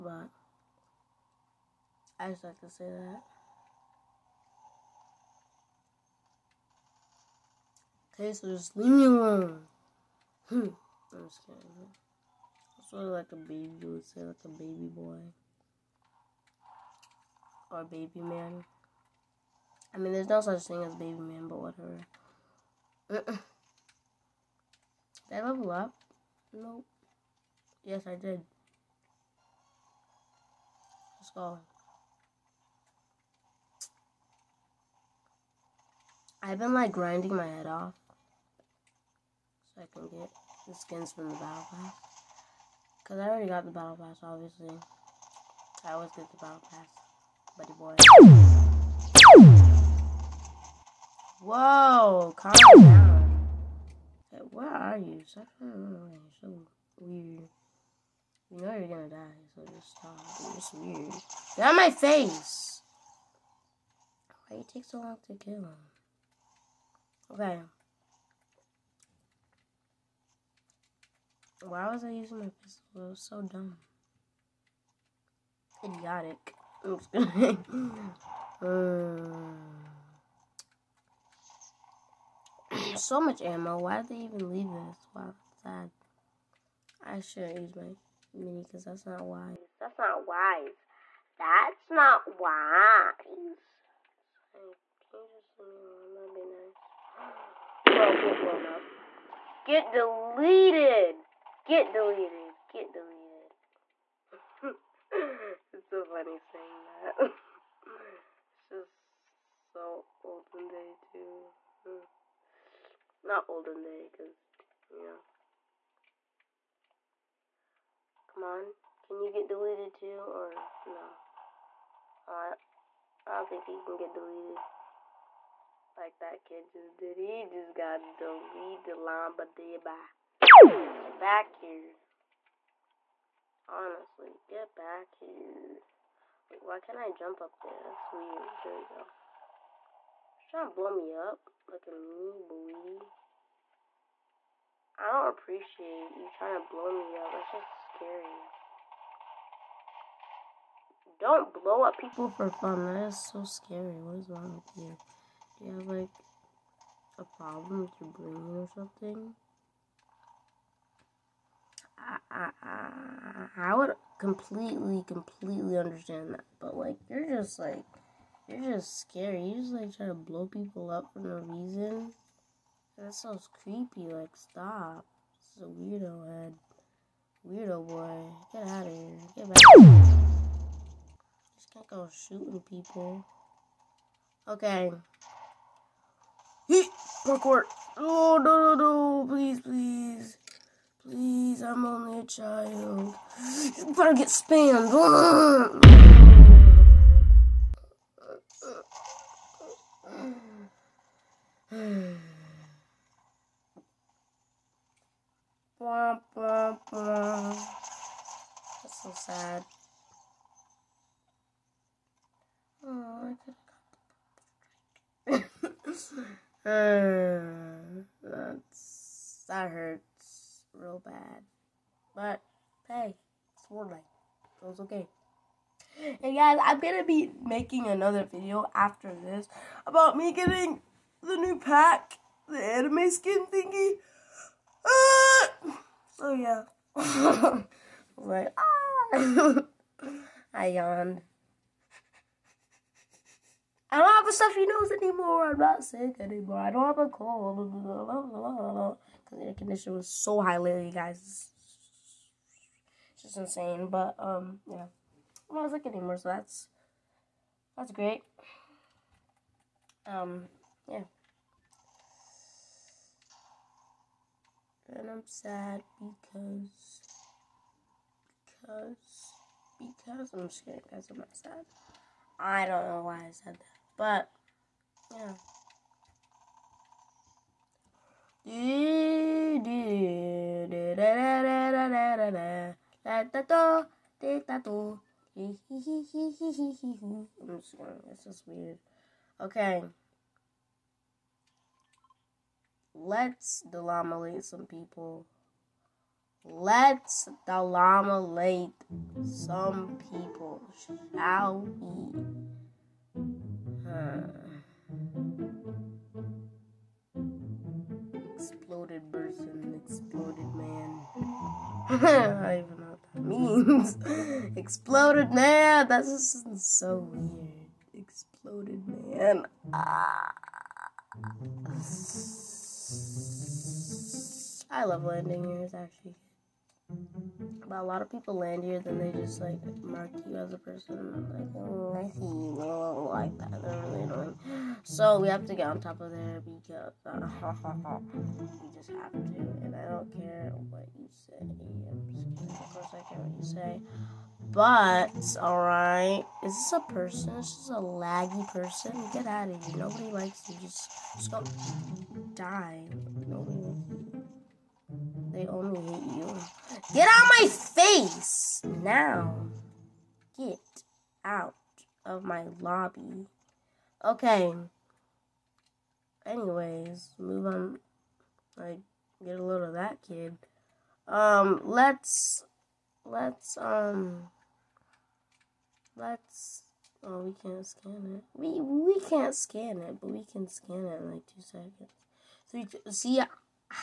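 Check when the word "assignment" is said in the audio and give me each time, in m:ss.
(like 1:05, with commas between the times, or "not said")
not said.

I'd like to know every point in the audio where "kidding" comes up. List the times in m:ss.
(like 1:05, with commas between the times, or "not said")
0:11, 4:30, 4:47.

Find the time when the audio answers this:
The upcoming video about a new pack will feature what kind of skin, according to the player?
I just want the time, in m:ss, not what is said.
3:52.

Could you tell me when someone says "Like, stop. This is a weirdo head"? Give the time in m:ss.
2:54.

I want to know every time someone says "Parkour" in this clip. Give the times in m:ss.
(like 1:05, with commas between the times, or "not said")
3:07.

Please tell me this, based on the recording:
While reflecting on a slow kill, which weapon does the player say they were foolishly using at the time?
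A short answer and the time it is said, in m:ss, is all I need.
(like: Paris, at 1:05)
pistol, at 1:12.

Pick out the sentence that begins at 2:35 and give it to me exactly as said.
Do you have, like, a problem with your brain or something?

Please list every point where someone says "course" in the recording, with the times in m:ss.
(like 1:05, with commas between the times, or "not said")
5:42.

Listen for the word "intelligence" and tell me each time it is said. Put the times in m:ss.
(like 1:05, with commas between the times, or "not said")
not said.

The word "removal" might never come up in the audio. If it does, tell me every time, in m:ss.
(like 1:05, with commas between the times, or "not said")
not said.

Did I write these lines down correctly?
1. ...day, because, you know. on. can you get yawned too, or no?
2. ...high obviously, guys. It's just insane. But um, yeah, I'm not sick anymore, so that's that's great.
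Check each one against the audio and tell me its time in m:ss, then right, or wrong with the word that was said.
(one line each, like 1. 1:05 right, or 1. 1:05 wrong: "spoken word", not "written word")
1. 1:53 wrong: "deleted", not "yawned"
2. 4:10 wrong: "lately", not "obviously".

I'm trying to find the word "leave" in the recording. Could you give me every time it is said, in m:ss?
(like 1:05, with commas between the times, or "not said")
0:08, 1:24.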